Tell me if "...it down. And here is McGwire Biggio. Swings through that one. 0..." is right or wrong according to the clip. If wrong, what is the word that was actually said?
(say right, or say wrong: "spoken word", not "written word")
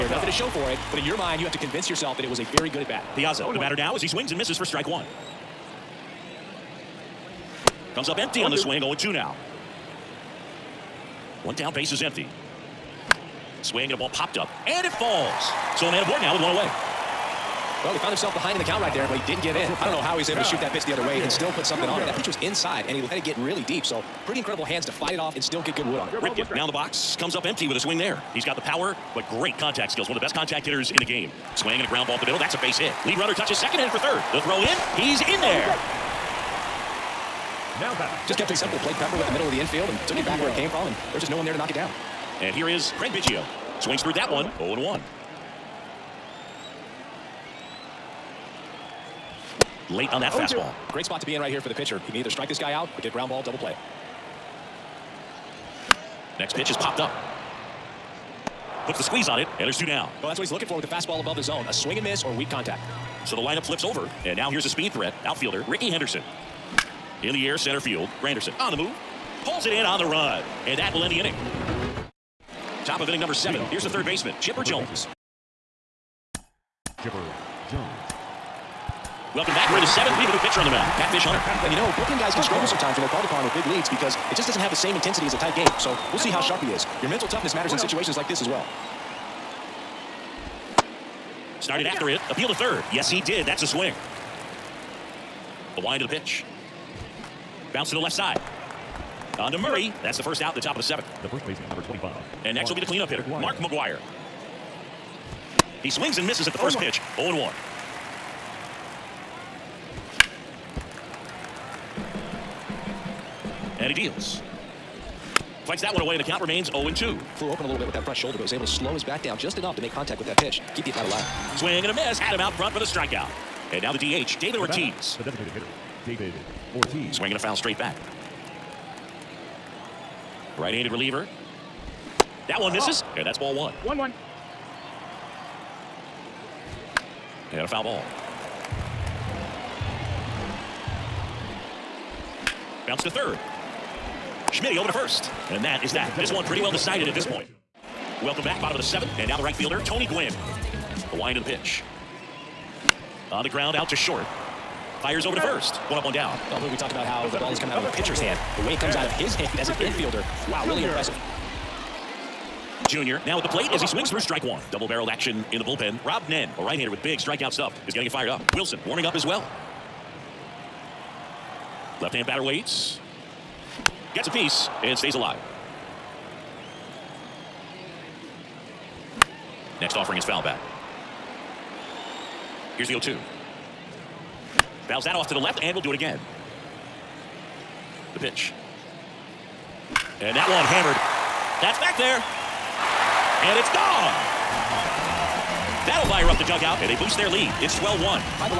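wrong: "Craig", not "McGwire".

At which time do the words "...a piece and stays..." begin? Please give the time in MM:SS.
02:54.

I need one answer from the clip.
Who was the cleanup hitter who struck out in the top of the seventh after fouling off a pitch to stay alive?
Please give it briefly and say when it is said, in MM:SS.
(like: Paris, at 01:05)
Mark McGwire, at 01:43.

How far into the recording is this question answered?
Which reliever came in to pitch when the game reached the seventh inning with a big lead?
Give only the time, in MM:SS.
01:20.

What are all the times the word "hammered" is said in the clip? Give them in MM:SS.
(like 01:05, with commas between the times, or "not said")
03:10.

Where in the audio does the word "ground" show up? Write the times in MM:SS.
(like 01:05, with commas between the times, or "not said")
00:31, 00:53, 02:33.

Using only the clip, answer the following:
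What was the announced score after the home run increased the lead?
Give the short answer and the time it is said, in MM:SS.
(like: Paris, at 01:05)
12-1, at 03:17.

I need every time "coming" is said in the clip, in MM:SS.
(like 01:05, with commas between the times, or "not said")
02:37.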